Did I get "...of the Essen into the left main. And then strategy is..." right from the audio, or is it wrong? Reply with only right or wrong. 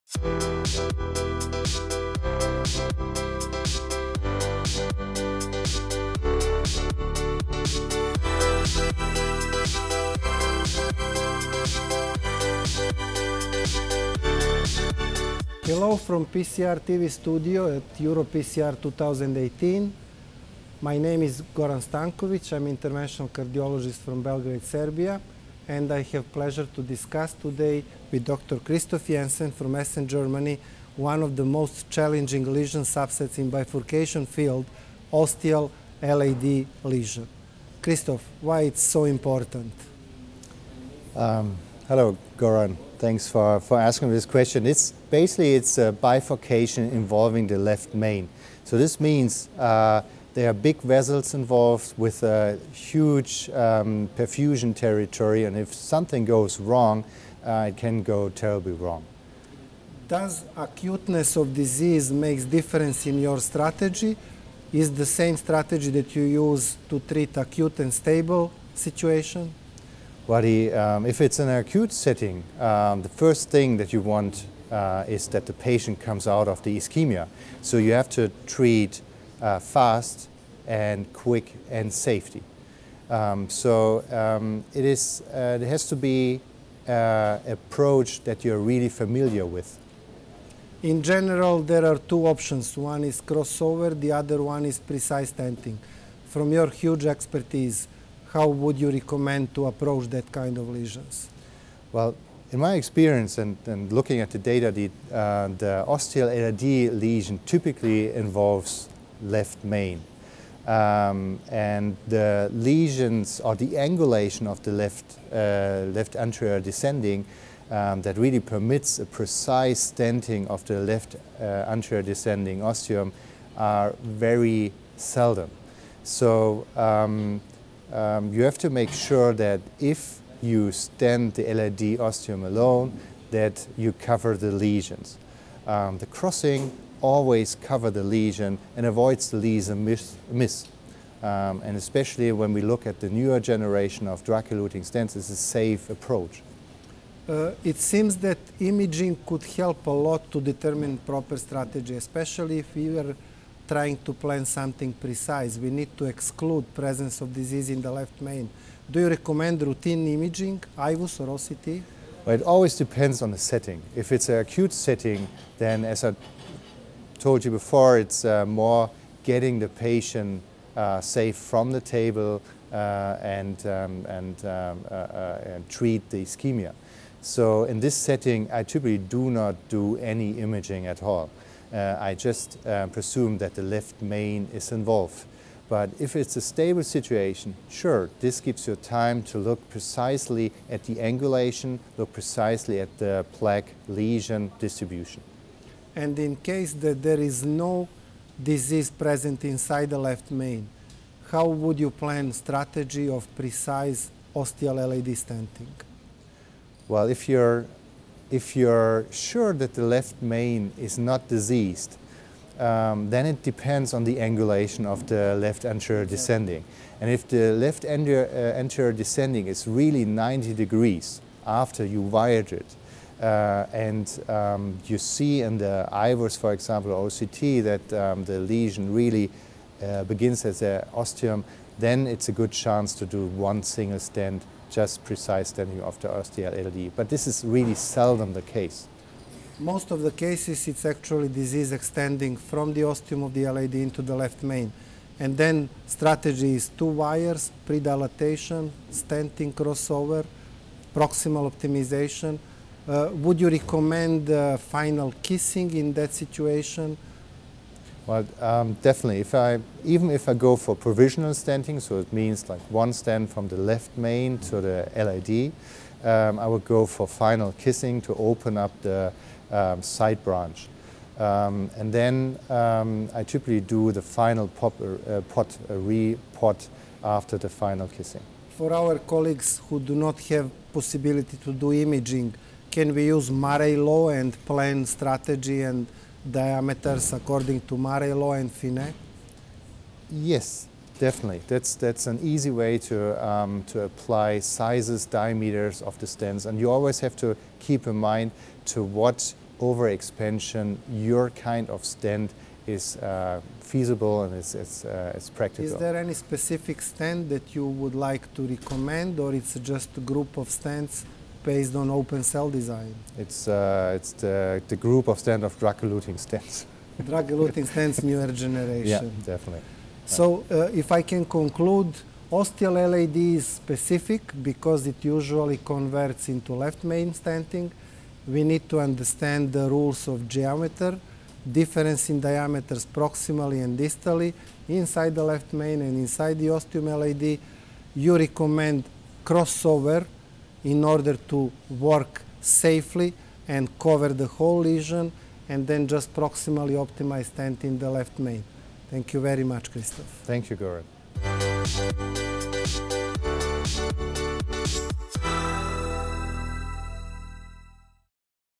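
wrong.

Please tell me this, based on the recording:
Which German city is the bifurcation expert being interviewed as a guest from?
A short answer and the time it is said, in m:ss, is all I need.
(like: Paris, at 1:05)
Essen, at 0:29.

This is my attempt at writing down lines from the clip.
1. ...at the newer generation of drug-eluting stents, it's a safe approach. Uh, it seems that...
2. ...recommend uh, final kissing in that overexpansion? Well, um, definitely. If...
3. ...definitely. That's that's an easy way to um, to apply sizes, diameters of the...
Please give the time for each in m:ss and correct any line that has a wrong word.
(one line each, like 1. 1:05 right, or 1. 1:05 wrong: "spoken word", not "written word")
1. 2:22 right
2. 4:13 wrong: "situation", not "overexpansion"
3. 4:50 right.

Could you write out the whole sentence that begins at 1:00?
Does acuteness of disease makes difference in your strategy?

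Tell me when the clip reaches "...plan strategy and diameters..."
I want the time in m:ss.
4:44.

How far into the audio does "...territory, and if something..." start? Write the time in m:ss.
0:54.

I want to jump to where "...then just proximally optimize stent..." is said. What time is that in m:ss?
5:45.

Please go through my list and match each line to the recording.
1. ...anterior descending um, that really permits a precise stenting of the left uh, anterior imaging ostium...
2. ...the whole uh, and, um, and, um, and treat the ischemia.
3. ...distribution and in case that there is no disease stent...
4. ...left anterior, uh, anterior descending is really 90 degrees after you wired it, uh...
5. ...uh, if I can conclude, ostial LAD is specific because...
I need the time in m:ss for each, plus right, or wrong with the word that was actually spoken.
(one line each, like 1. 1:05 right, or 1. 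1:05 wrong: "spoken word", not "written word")
1. 1:56 wrong: "descending", not "imaging"
2. 2:51 wrong: "table", not "whole"
3. 3:14 wrong: "present", not "stent"
4. 3:37 right
5. 5:20 right.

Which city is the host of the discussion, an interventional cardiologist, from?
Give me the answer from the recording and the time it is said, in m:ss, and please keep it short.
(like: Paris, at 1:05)
Belgrade, at 0:24.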